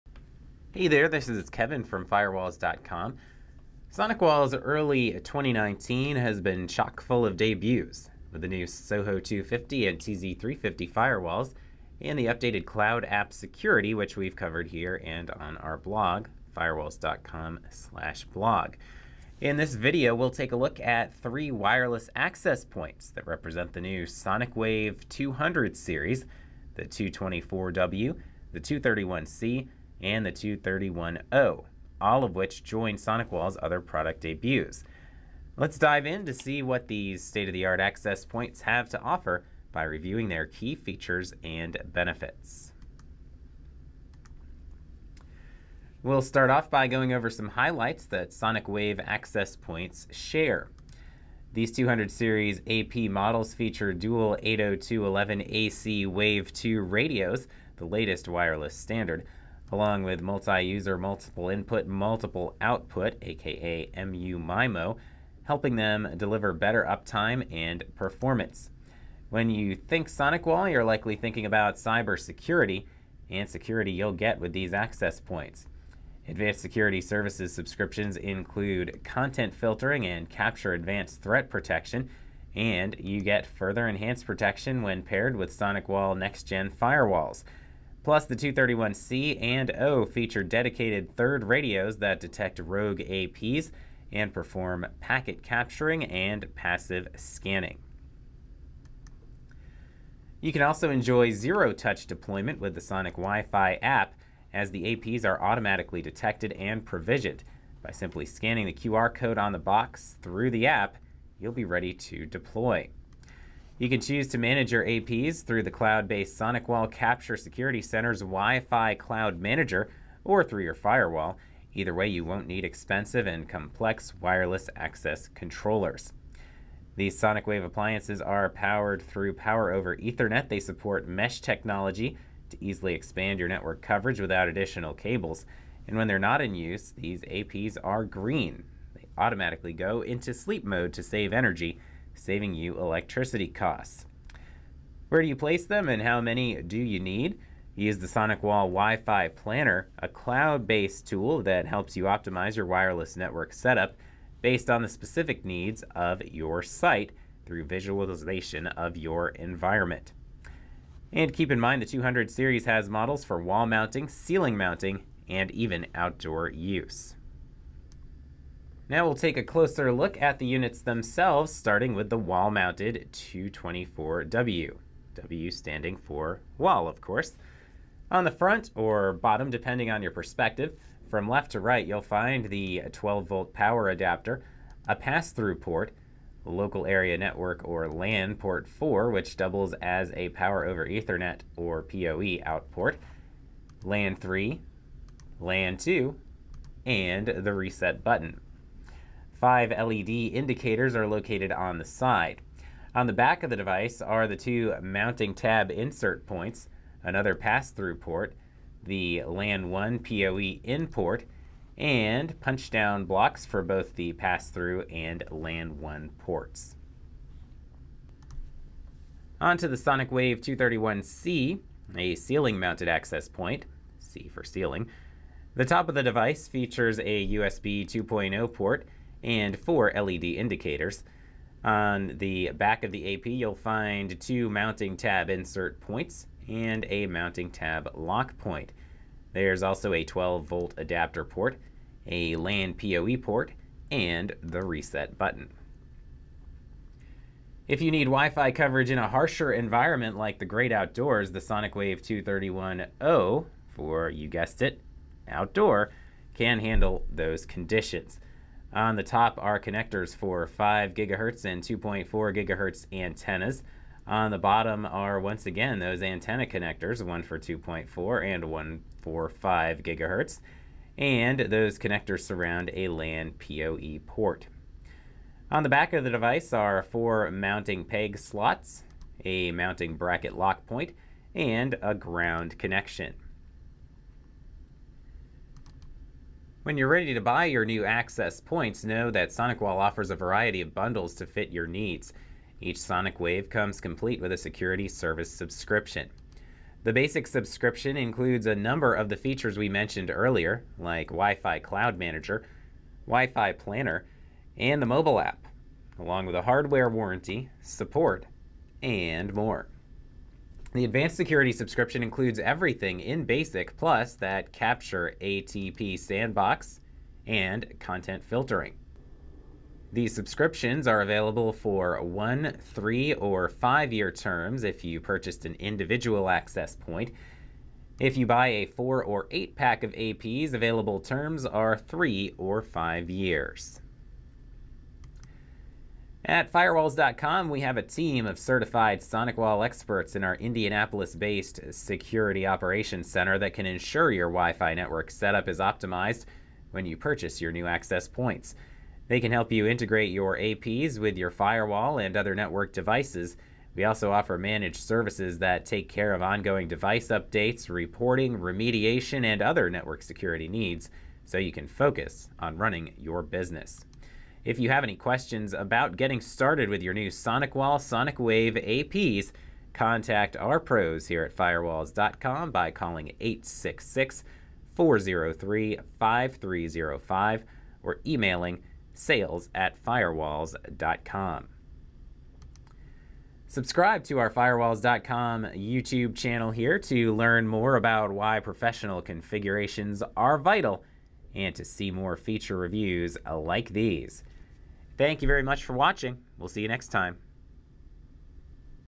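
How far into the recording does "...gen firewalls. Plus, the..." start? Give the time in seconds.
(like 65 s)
86 s.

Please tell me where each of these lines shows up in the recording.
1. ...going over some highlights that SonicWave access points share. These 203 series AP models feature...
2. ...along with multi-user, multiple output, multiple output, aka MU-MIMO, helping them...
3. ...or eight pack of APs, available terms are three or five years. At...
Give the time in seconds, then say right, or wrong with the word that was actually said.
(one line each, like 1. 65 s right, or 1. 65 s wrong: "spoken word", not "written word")
1. 46 s wrong: "200", not "203"
2. 59 s wrong: "input", not "output"
3. 329 s right.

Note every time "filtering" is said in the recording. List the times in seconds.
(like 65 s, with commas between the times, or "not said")
79 s, 318 s.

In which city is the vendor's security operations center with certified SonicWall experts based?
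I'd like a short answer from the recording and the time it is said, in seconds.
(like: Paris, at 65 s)
Indianapolis, at 340 s.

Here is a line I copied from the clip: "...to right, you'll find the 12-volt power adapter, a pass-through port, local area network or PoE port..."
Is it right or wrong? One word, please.
wrong.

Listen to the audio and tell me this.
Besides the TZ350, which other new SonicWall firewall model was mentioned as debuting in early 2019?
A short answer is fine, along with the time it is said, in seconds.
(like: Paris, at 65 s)
Soho 250, at 8 s.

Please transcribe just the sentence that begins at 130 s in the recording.
They support mesh technology to easily expand your network coverage without additional cables.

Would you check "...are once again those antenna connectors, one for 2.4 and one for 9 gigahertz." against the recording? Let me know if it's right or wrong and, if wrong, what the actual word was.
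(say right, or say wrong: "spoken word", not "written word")
wrong: "5", not "9".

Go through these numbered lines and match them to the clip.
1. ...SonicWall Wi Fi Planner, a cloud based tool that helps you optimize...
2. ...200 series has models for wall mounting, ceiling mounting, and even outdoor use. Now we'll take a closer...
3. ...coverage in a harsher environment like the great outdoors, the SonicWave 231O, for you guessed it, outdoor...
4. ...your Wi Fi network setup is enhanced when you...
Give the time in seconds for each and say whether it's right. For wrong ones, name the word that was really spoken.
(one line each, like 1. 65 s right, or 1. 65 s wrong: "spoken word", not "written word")
1. 148 s right
2. 161 s right
3. 248 s right
4. 344 s wrong: "optimized", not "enhanced".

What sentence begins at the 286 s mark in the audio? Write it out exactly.
When you're ready to buy your new access points, know that SonicWall offers a variety of bundles to fit your needs.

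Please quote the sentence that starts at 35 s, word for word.
Let's dive in to see what these state-of-the-art access points have to offer by reviewing their key features and benefits.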